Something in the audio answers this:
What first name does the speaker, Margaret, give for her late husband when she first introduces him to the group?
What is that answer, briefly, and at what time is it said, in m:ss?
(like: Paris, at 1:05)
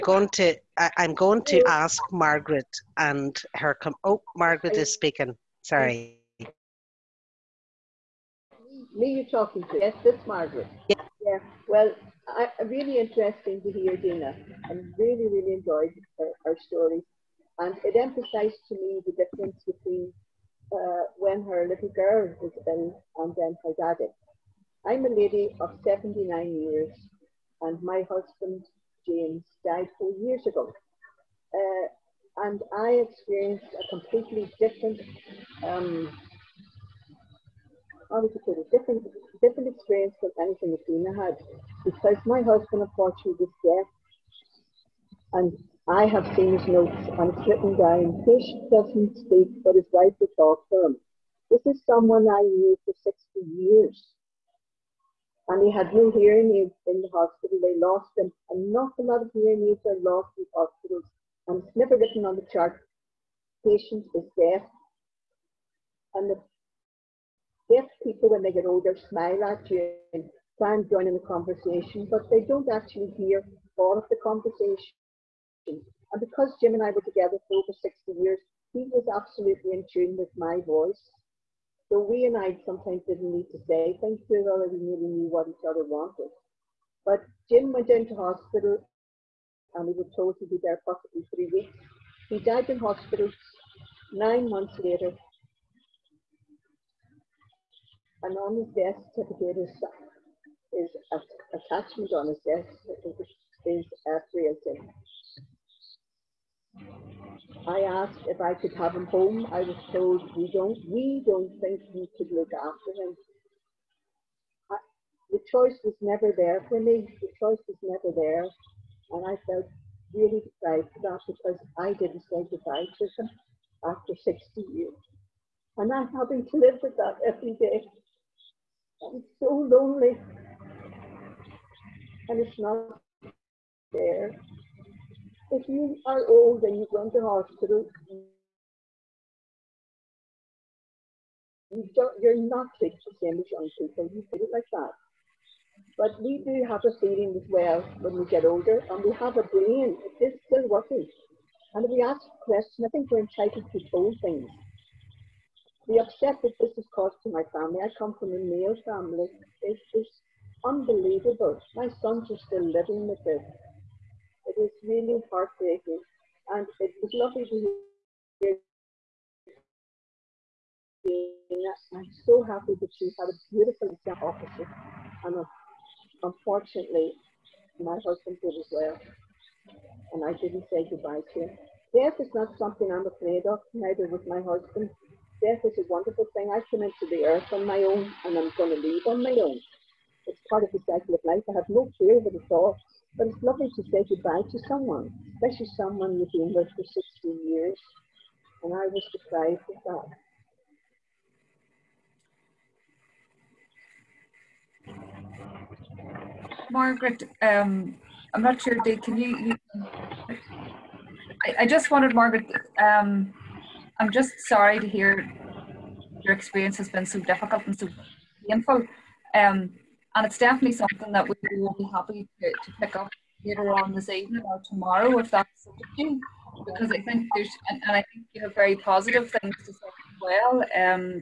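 James, at 0:29.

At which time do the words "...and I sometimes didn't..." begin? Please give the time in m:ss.
1:22.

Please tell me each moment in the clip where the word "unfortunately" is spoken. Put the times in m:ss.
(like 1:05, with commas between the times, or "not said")
0:42, 2:56.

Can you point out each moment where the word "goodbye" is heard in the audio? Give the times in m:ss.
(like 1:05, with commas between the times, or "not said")
2:02, 3:00, 3:14.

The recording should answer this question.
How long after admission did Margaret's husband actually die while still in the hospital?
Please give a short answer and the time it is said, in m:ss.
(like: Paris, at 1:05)
9 months, at 1:34.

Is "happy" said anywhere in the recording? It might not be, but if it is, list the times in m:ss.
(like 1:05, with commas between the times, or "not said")
2:52, 3:41.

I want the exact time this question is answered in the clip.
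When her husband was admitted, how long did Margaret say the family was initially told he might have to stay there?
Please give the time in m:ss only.
1:31.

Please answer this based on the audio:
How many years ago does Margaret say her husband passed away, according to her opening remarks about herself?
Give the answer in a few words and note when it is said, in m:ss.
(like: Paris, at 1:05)
4, at 0:29.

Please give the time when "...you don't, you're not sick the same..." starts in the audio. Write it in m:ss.
2:21.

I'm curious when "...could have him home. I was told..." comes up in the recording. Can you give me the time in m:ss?
1:48.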